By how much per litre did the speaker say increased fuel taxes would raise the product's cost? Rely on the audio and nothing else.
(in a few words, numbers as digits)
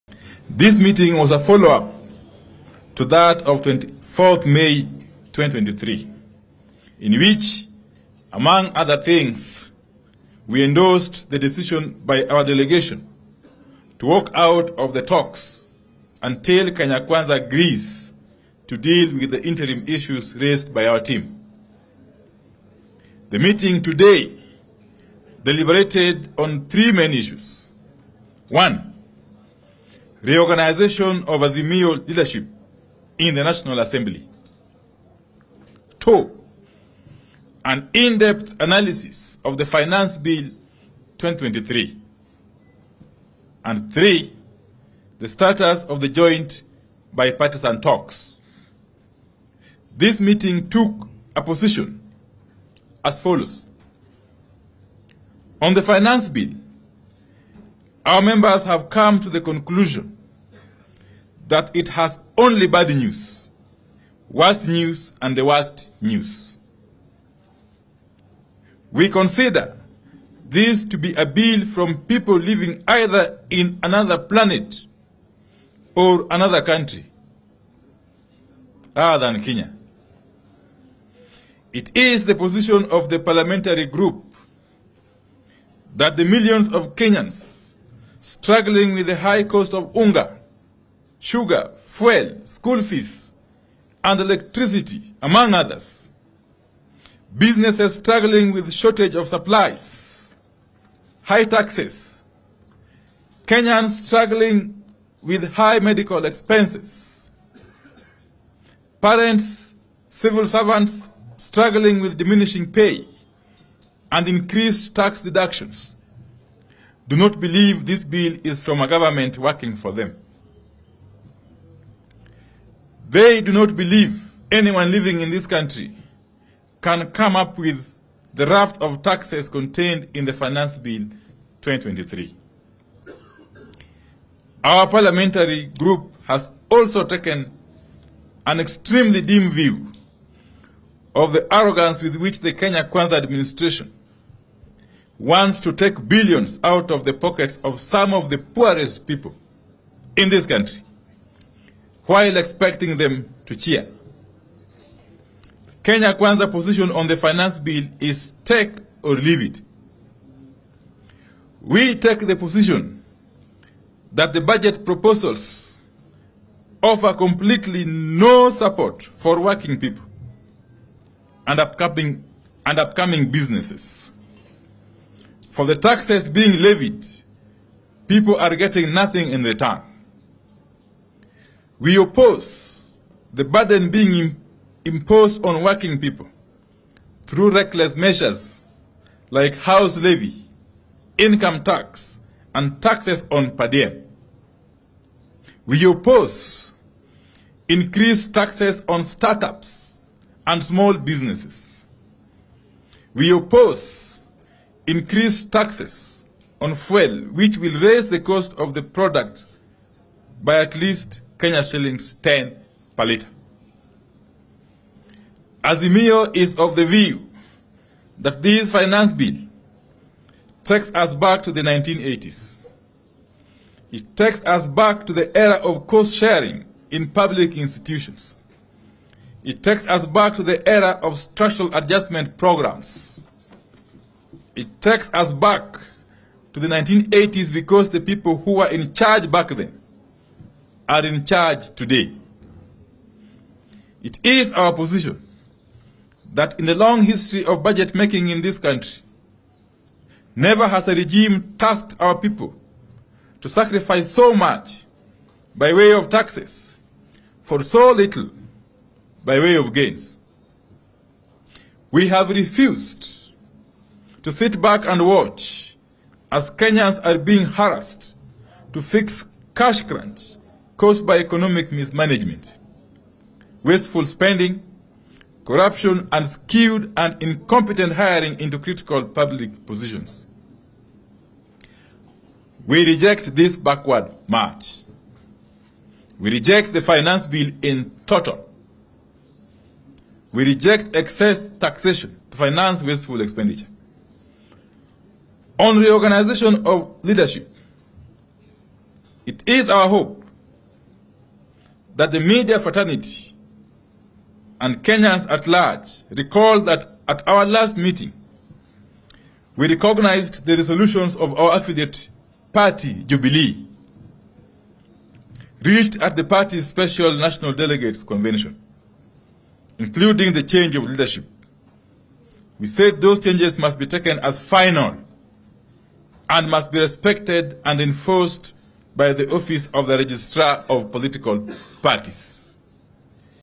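Kenya shillings 10.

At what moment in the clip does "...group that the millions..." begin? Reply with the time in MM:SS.
01:23.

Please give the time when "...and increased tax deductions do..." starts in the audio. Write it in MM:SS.
01:54.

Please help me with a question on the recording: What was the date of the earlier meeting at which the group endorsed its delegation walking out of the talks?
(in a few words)
24th May 2023.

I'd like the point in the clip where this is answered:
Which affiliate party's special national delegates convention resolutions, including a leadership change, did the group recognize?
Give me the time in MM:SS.
05:13.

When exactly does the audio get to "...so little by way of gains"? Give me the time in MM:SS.
04:17.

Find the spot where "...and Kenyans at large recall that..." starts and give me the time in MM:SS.
05:04.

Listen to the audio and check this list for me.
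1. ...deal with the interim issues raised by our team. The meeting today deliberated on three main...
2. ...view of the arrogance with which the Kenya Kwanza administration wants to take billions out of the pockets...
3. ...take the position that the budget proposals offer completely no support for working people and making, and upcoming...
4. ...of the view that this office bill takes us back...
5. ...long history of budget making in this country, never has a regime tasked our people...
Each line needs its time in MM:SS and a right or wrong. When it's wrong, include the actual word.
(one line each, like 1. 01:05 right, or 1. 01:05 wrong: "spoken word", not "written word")
1. 00:18 right
2. 02:19 right
3. 02:41 wrong: "upcoming", not "making"
4. 03:36 wrong: "finance", not "office"
5. 04:06 right.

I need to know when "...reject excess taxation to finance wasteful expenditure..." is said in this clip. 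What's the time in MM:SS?
04:50.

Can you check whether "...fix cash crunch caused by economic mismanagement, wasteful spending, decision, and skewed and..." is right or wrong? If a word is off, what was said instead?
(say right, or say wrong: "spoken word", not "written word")
wrong: "corruption", not "decision".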